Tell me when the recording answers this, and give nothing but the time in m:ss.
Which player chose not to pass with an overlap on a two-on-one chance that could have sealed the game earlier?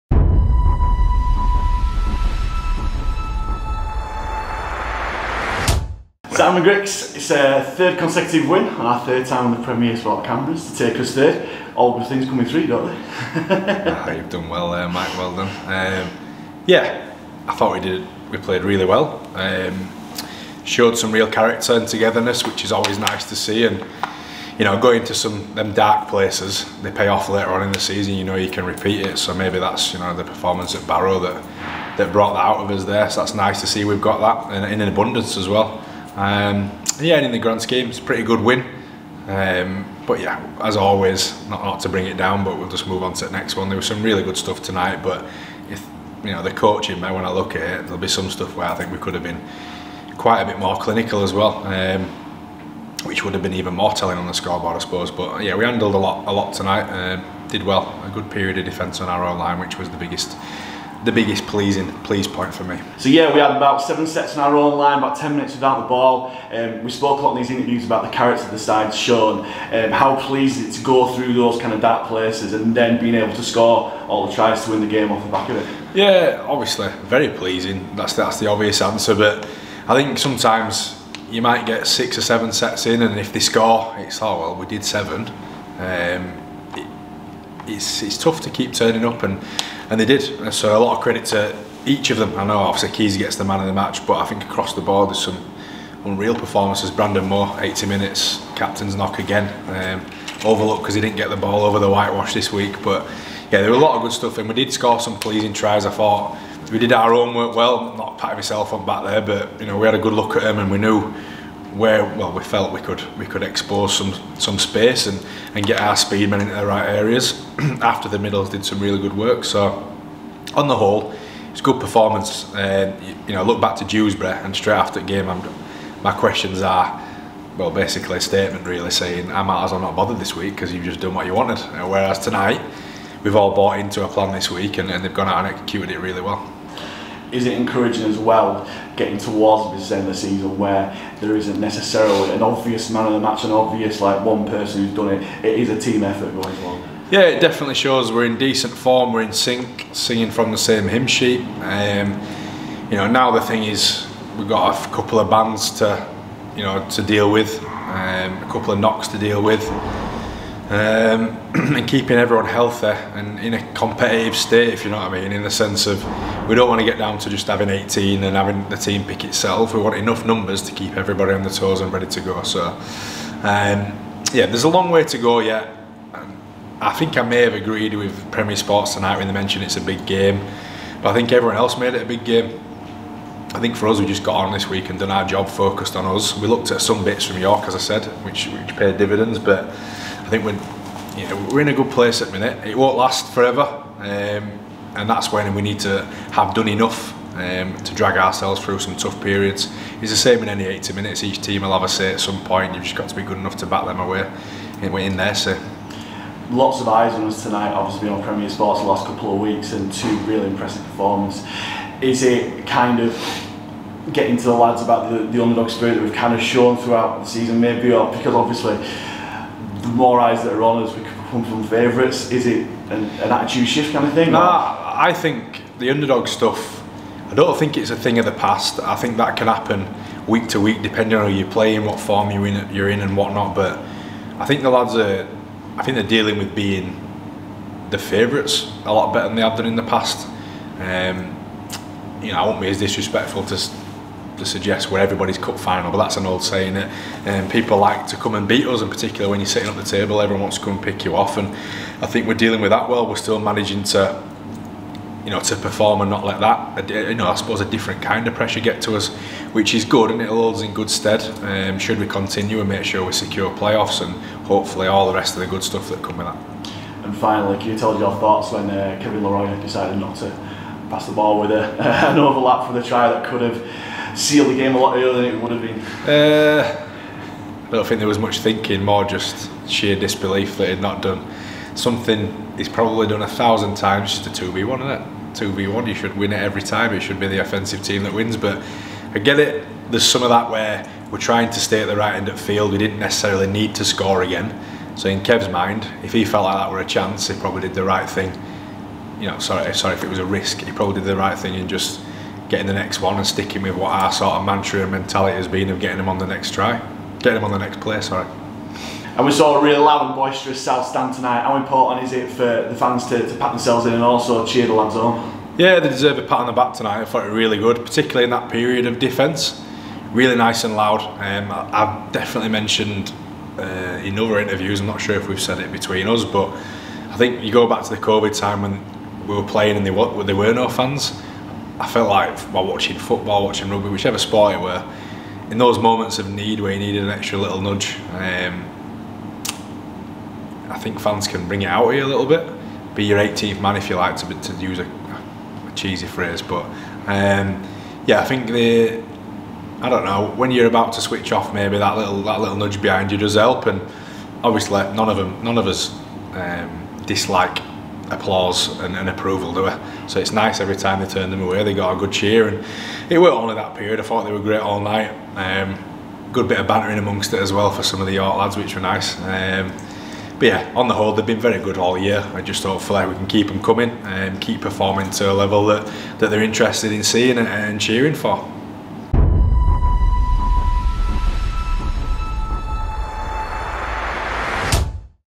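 4:29.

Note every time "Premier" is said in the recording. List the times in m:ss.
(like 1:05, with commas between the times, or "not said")
0:09, 2:58, 3:28.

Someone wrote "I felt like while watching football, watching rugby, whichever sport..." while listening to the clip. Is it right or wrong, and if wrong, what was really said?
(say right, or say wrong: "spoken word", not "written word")
right.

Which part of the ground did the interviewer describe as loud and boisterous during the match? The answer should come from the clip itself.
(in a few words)
South stand.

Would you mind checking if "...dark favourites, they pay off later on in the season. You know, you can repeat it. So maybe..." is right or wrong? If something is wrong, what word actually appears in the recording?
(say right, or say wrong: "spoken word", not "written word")
wrong: "places", not "favourites".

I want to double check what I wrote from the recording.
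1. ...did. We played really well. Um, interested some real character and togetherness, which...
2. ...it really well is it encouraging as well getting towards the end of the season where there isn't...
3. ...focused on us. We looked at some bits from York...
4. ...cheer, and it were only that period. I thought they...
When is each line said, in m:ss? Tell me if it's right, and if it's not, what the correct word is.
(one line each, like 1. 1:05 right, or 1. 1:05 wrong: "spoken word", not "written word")
1. 0:17 wrong: "showed", not "interested"
2. 2:15 right
3. 3:05 right
4. 6:02 right.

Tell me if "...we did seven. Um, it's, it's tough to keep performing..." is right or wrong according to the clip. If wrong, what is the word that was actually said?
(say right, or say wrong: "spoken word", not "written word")
wrong: "turning", not "performing".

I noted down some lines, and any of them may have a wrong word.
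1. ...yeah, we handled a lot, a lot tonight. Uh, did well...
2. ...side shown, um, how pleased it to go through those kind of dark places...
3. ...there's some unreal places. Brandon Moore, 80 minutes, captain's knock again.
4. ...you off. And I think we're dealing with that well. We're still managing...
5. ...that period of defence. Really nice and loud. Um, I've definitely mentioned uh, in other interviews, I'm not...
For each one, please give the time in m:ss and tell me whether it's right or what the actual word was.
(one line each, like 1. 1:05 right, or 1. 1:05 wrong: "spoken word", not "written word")
1. 0:55 right
2. 1:08 right
3. 1:35 wrong: "performances", not "places"
4. 4:11 right
5. 5:18 right.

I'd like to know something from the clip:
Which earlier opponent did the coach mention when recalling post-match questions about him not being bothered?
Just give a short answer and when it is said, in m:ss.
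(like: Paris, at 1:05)
Dewsbury, at 2:03.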